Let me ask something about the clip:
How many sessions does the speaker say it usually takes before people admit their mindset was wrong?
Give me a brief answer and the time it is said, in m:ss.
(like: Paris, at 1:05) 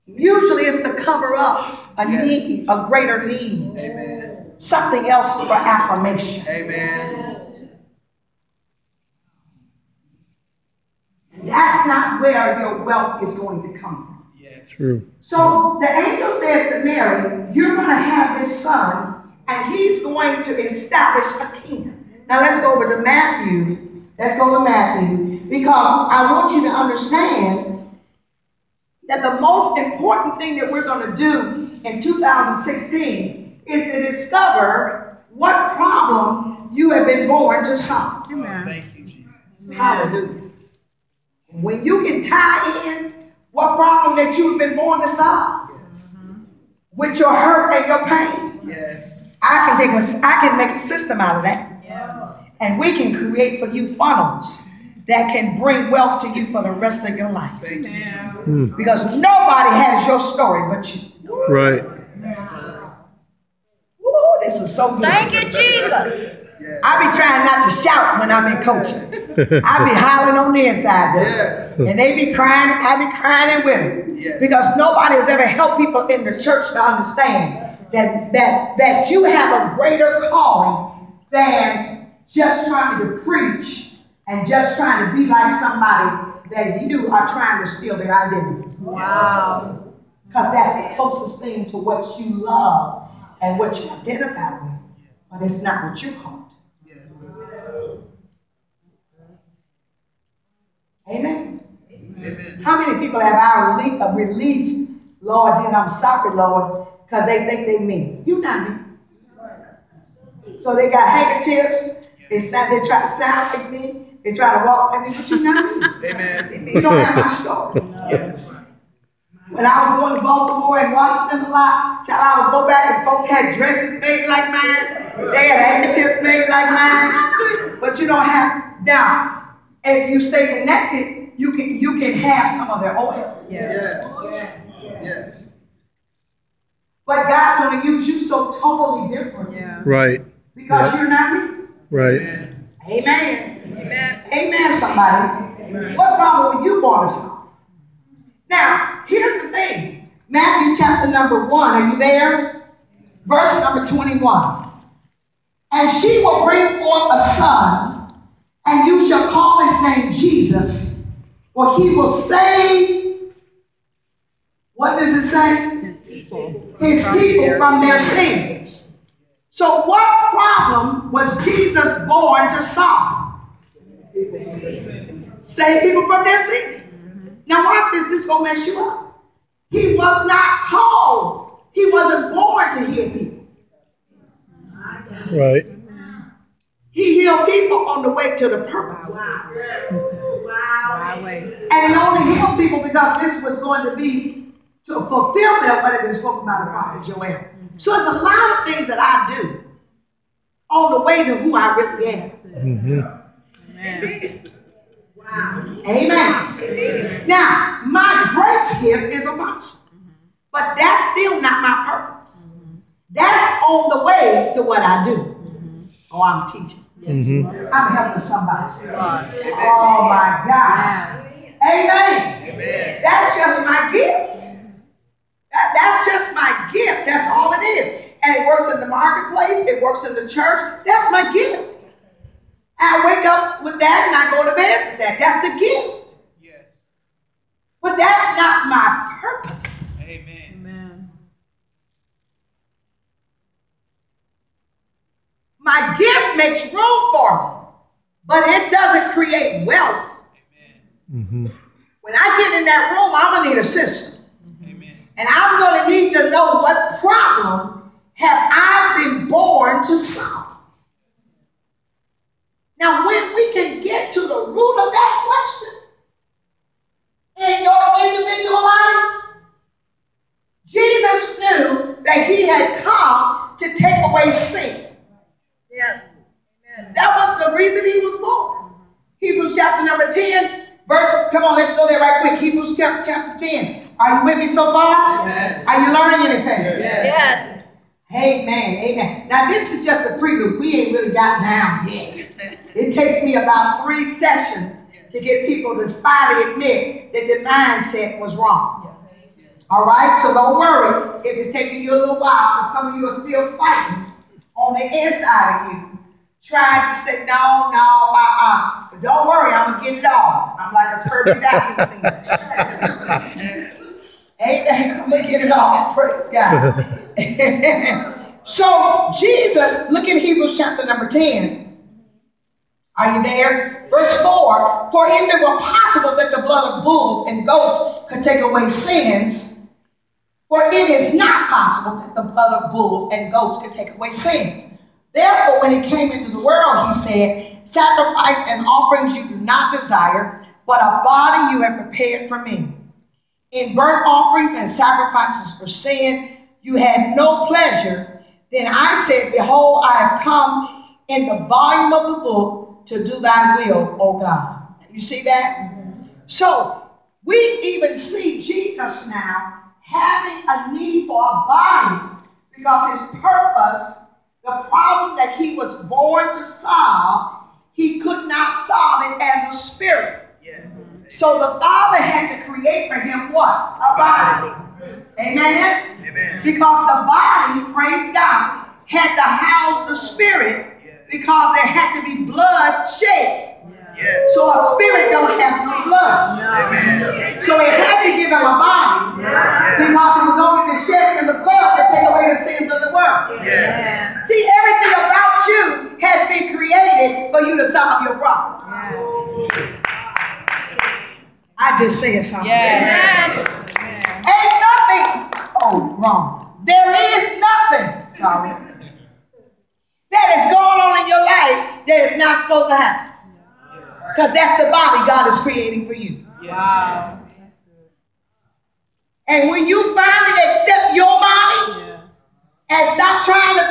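3, at 4:53.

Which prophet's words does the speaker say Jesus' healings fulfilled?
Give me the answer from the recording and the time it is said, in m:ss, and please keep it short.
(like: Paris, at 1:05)
Joel, at 3:16.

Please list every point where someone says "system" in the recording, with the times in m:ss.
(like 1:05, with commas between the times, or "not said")
0:50, 4:13.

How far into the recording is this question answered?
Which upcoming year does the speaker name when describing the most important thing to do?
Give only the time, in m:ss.
0:32.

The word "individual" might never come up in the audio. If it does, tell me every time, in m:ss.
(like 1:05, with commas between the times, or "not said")
4:28.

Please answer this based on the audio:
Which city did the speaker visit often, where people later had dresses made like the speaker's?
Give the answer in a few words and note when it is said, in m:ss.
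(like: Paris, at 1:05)
Baltimore, at 2:00.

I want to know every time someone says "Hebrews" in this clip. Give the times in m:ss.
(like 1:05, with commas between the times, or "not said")
4:42, 5:20.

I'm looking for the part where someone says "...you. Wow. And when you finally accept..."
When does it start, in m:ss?
6:55.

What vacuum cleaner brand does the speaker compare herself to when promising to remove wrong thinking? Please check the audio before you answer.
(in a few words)
Kirby.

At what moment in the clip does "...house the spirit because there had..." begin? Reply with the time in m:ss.
6:19.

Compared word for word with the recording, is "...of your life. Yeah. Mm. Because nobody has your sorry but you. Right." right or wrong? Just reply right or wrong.
wrong.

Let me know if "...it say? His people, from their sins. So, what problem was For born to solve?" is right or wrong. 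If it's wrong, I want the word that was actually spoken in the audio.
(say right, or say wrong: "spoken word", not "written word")
wrong: "Jesus", not "For".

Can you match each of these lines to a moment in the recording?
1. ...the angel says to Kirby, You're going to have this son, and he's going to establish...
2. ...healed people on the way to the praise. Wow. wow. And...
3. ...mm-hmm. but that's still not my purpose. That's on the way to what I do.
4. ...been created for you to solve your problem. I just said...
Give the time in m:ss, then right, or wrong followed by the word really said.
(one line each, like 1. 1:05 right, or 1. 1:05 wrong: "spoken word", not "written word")
1. 0:15 wrong: "Mary", not "Kirby"
2. 3:07 wrong: "purpose", not "praise"
3. 3:29 right
4. 6:36 right.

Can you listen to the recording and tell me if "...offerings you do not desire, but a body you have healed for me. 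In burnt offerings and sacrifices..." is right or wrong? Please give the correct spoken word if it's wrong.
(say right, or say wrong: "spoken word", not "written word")
wrong: "prepared", not "healed".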